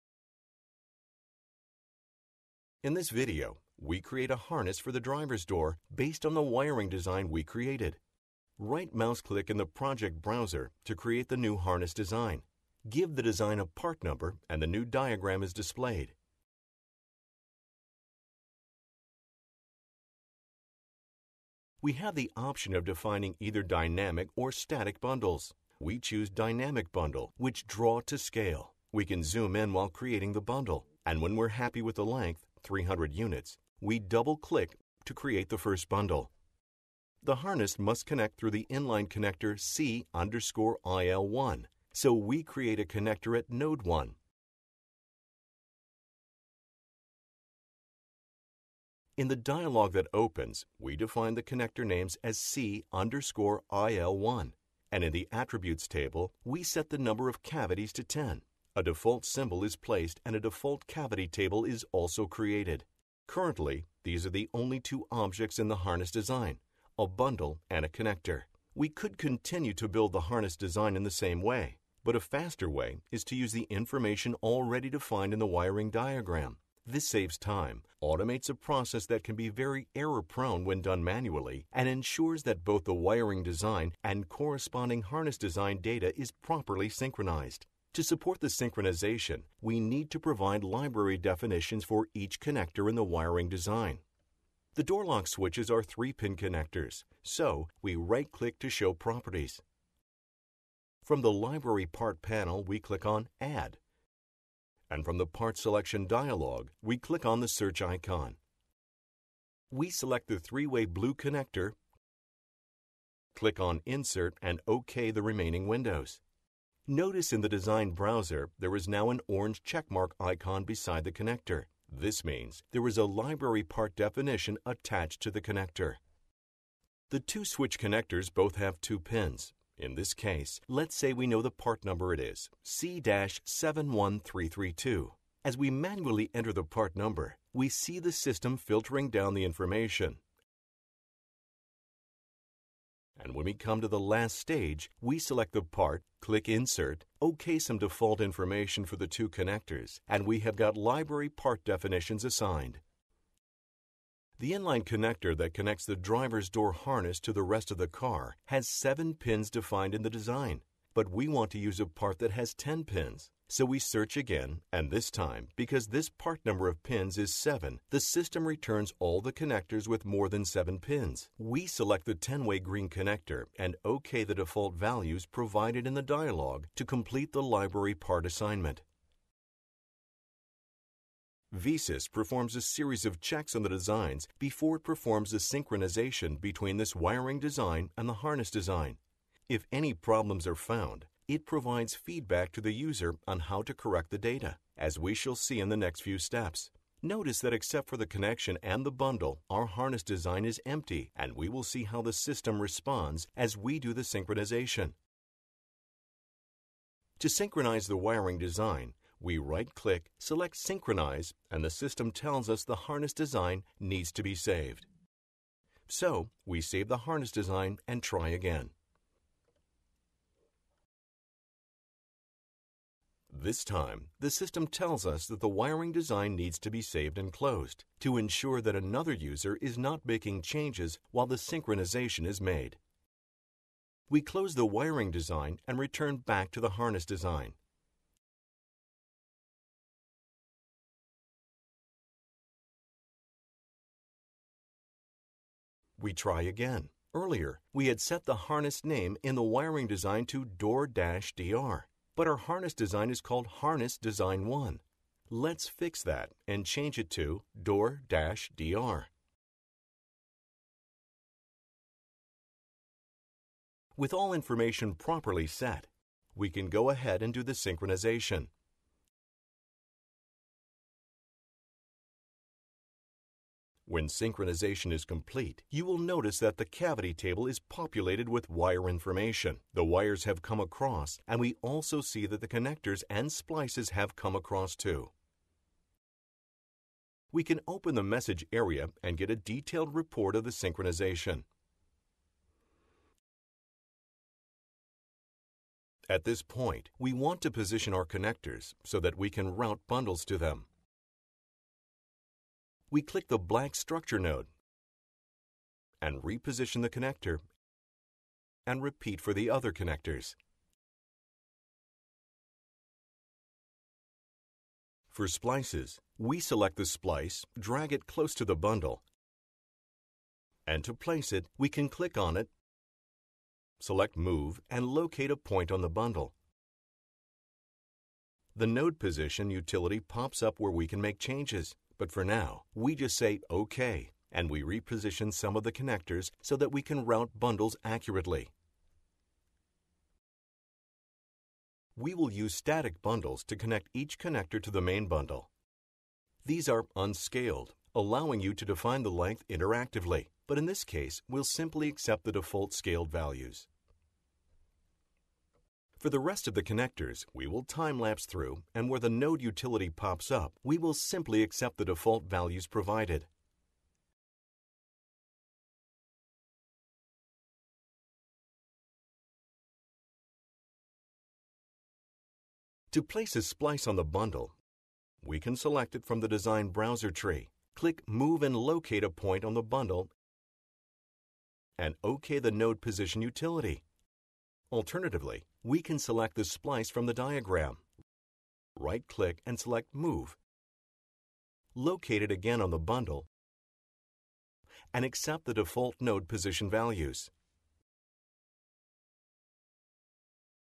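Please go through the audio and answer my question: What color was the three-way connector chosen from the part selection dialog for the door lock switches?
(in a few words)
Blue.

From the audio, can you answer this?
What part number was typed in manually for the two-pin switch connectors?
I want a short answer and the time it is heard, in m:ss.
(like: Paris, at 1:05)
C-71332, at 2:12.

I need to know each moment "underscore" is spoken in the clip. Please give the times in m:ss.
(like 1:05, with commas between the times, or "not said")
0:40, 0:52.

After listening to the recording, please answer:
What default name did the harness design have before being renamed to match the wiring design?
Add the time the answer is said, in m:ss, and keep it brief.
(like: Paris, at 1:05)
Harness Design 1, at 4:13.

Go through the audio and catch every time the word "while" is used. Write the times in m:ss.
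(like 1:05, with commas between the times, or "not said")
0:29, 3:51.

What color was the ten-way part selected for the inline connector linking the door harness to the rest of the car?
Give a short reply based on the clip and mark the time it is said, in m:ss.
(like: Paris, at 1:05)
Green, at 2:52.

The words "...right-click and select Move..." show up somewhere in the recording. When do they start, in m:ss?
6:28.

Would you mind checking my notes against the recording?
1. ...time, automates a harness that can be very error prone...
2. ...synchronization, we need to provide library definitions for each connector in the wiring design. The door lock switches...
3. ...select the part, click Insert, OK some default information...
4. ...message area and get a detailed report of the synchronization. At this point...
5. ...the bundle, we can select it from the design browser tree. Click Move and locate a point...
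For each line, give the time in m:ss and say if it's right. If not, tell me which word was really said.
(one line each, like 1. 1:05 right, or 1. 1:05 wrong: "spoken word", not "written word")
1. 1:17 wrong: "process", not "harness"
2. 1:28 right
3. 2:25 right
4. 4:48 right
5. 6:13 right.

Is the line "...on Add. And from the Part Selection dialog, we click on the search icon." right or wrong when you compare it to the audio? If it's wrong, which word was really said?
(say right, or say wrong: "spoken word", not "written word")
right.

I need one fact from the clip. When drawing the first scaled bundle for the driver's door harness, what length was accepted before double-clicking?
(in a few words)
300 units.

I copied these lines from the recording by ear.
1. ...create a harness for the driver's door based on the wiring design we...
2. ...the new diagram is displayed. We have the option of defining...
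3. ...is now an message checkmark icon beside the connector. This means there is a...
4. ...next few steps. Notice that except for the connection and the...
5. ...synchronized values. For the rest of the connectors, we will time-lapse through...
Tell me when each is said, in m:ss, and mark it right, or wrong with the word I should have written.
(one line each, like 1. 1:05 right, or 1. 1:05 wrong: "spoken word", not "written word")
1. 0:04 right
2. 0:14 right
3. 1:58 wrong: "orange", not "message"
4. 3:15 right
5. 5:52 wrong: "scaled", not "synchronized".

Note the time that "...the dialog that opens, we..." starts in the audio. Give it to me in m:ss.
0:49.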